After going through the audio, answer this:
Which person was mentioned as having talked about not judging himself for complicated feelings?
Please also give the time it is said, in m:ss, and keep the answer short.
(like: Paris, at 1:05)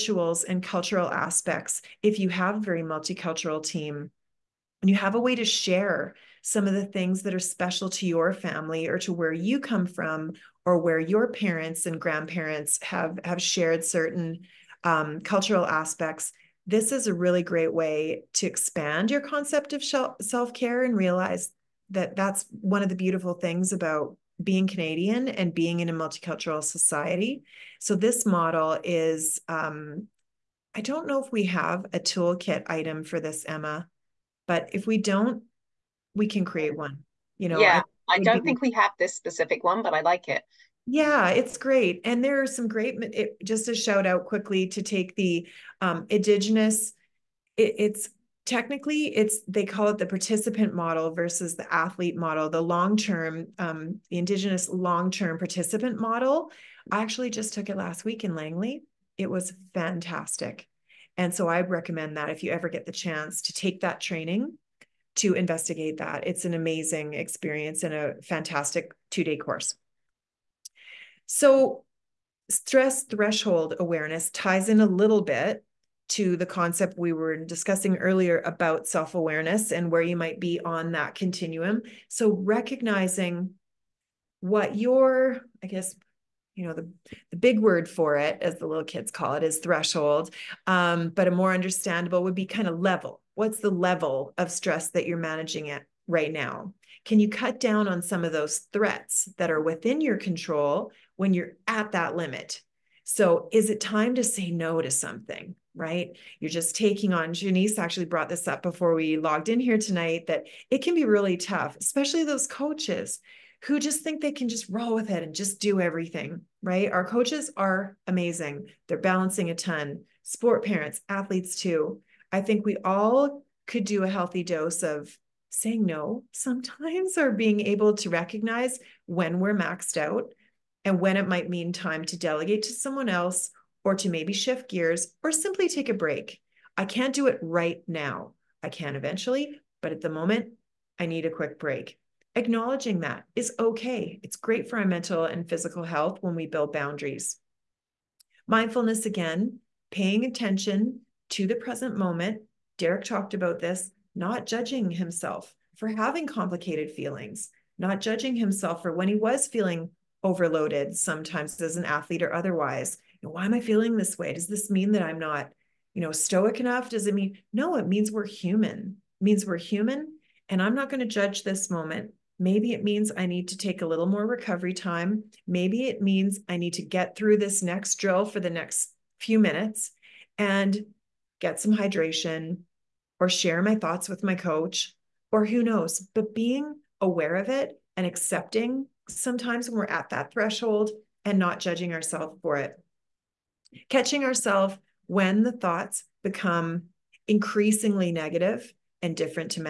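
Derek, at 2:32.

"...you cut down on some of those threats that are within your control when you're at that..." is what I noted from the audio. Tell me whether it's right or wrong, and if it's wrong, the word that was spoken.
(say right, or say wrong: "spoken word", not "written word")
right.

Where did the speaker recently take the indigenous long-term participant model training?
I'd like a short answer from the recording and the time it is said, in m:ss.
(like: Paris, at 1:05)
Langley, at 0:58.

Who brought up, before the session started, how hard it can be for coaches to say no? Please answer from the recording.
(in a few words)
Janice.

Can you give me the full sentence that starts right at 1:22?
So, recognizing what your, I guess, you know, the, the big word for it, as the little kids call it, is threshold.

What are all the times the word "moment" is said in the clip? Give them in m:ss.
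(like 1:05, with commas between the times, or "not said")
2:20, 2:31, 2:51.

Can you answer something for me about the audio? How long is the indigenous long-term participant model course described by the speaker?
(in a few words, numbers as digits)
2 days.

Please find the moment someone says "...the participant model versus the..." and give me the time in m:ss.
0:49.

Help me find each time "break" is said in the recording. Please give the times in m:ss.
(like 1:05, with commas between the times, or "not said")
2:15, 2:21.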